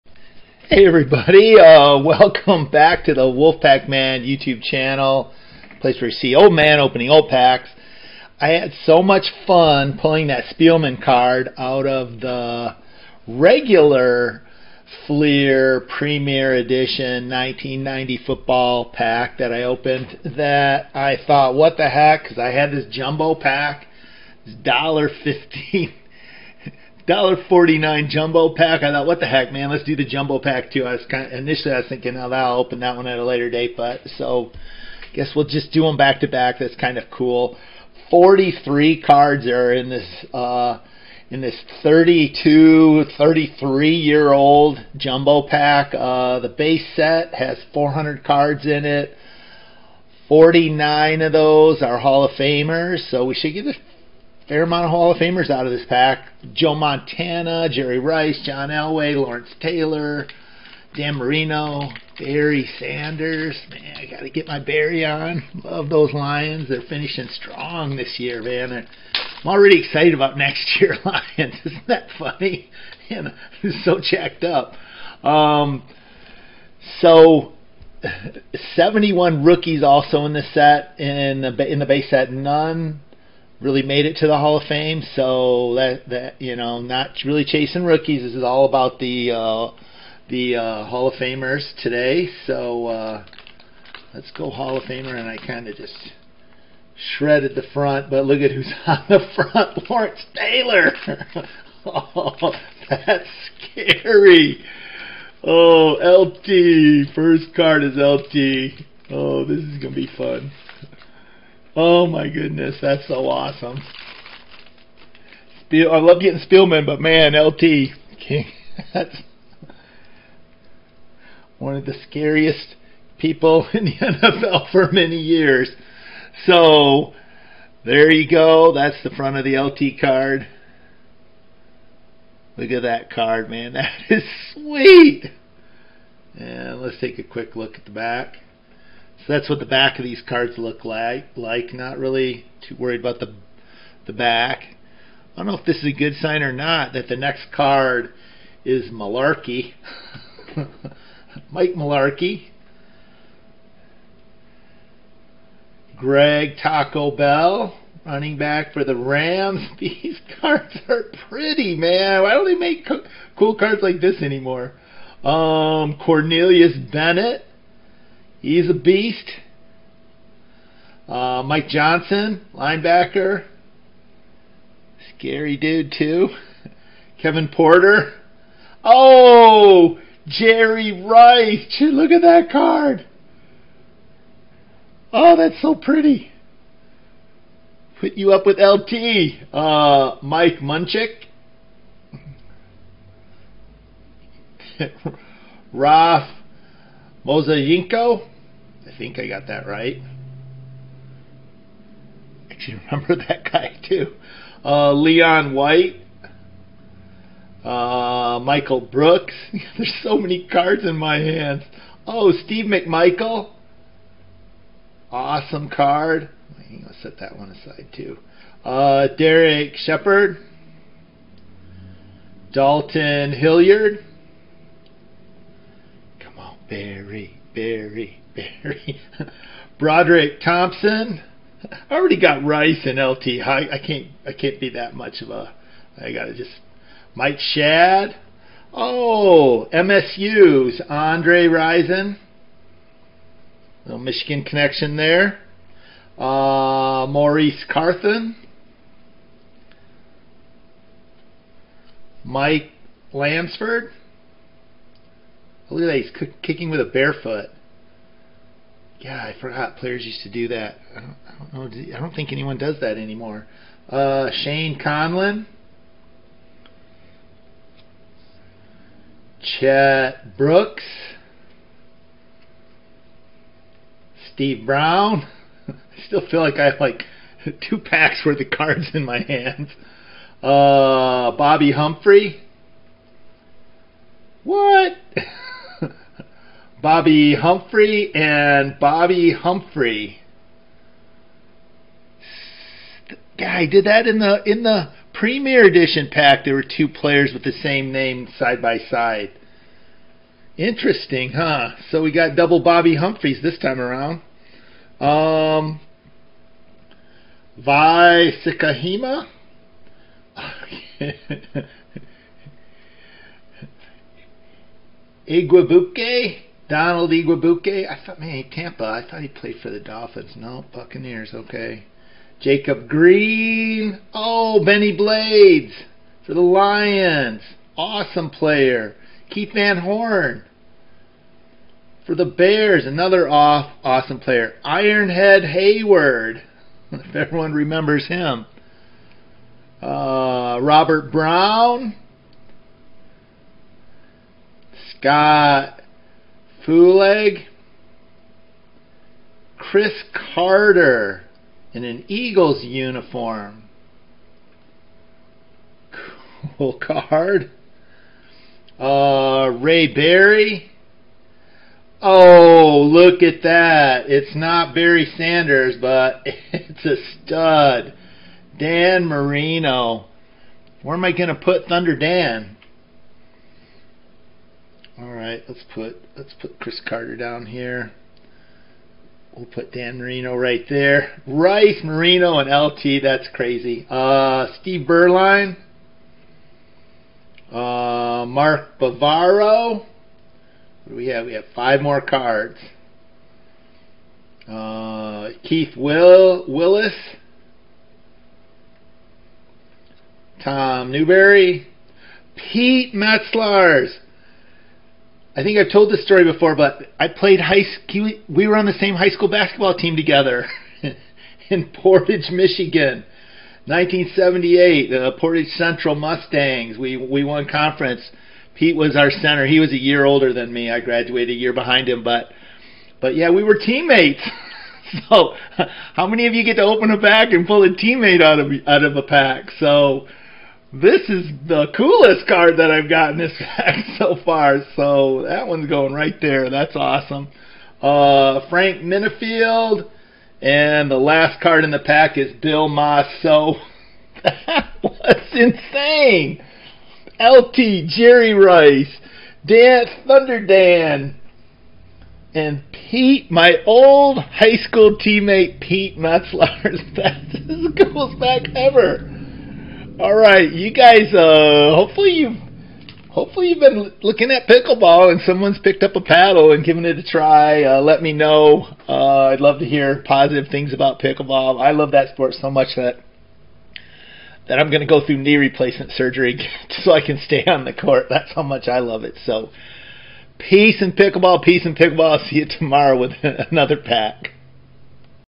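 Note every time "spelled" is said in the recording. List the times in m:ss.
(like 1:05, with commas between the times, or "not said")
not said.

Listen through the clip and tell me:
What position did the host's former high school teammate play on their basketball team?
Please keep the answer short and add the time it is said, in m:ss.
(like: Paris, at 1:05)
Center, at 6:59.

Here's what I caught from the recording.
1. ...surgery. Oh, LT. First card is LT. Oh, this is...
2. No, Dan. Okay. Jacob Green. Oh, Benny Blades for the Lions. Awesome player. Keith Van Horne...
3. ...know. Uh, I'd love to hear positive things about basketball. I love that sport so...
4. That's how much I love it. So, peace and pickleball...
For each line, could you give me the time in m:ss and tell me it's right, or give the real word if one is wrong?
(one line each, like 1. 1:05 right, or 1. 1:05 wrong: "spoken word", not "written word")
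1. 1:43 wrong: "scary", not "surgery"
2. 5:20 wrong: "Buccaneers", not "Dan"
3. 7:48 wrong: "pickleball", not "basketball"
4. 7:58 right.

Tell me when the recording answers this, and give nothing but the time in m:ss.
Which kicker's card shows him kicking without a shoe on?
4:12.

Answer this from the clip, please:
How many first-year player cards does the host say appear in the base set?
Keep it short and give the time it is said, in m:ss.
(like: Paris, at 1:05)
71, at 1:18.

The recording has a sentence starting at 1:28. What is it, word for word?
This is all about the uh, the uh, Hall of Famers today.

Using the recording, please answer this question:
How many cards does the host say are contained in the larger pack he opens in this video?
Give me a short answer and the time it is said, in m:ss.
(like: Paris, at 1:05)
43, at 0:38.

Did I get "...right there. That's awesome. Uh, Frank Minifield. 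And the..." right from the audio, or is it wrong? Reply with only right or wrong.
right.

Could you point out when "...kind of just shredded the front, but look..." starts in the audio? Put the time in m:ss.
1:35.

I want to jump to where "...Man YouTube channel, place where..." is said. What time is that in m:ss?
0:03.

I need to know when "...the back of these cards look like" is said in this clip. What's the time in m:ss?
2:19.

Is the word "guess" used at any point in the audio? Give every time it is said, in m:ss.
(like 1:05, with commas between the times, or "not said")
0:35.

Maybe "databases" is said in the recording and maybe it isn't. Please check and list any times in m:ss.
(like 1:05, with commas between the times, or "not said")
not said.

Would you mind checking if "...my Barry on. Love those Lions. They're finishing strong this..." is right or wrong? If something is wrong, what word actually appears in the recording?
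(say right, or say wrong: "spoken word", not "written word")
right.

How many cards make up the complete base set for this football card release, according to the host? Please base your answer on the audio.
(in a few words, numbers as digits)
400.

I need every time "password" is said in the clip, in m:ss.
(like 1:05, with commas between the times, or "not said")
not said.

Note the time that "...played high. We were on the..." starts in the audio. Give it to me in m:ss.
6:47.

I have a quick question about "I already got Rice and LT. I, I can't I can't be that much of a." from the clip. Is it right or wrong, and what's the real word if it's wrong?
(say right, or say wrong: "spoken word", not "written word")
right.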